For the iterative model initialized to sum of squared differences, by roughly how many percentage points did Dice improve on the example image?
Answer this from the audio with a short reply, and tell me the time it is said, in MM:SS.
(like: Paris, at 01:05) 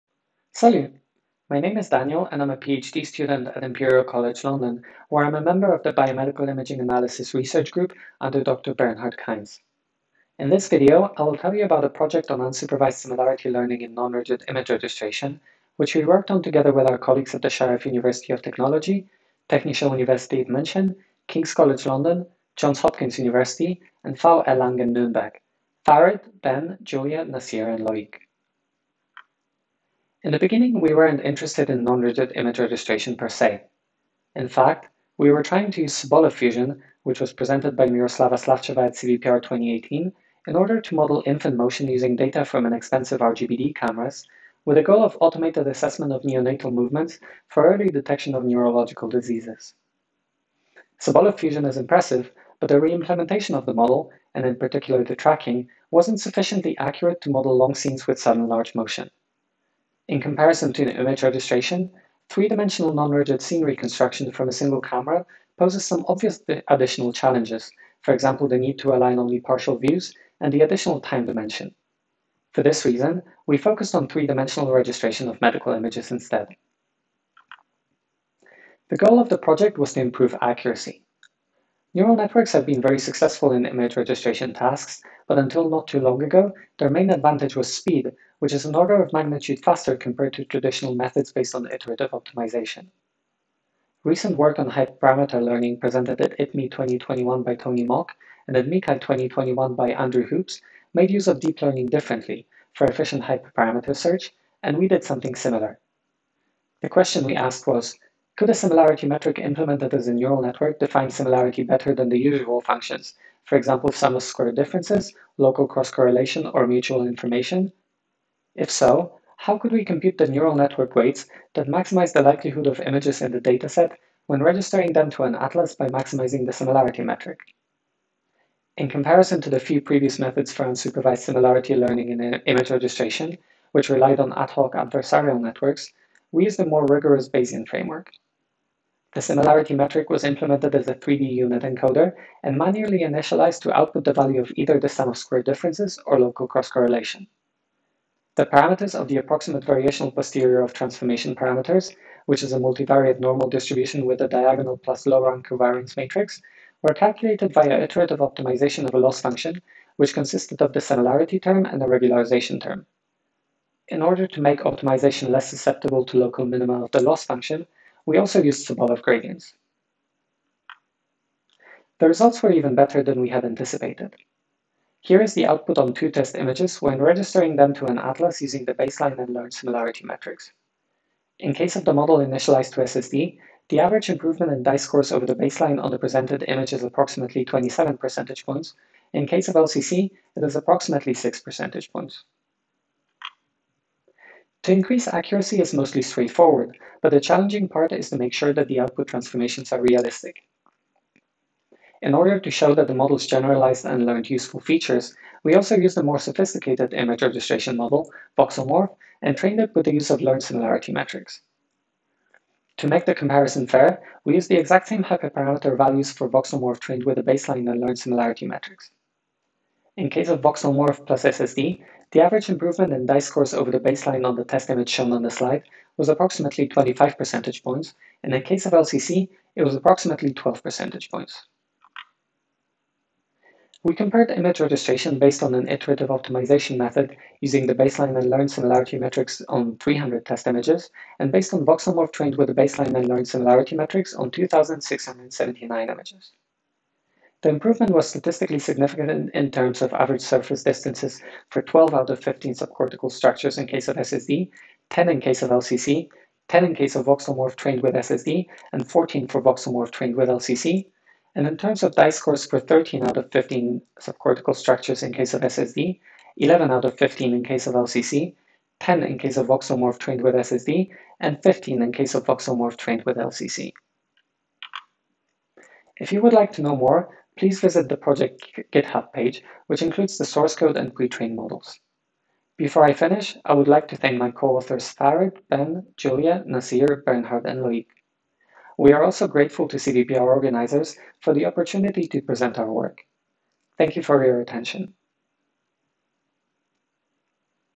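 27, at 03:07.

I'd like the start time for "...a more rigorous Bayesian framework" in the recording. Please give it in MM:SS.
02:16.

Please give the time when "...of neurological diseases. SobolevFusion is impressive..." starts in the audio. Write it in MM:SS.
00:48.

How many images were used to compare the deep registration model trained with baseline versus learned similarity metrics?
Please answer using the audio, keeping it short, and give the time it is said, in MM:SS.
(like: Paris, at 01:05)
2,679, at 04:04.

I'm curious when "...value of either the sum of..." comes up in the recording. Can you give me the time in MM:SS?
02:24.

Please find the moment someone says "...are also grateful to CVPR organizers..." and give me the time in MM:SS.
04:48.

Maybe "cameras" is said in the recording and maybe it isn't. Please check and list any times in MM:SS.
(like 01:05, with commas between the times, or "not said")
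00:43, 01:04.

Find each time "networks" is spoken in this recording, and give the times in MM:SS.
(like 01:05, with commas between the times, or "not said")
01:22, 01:50, 02:00, 02:15.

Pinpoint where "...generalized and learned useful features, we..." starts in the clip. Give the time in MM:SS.
03:23.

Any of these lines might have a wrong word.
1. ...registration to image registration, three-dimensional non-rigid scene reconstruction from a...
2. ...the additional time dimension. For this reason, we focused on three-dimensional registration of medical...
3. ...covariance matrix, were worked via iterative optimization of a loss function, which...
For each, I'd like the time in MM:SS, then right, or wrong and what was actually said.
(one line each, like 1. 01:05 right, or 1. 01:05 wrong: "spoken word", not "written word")
1. 01:00 wrong: "comparison", not "registration"
2. 01:10 right
3. 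02:35 wrong: "calculated", not "worked".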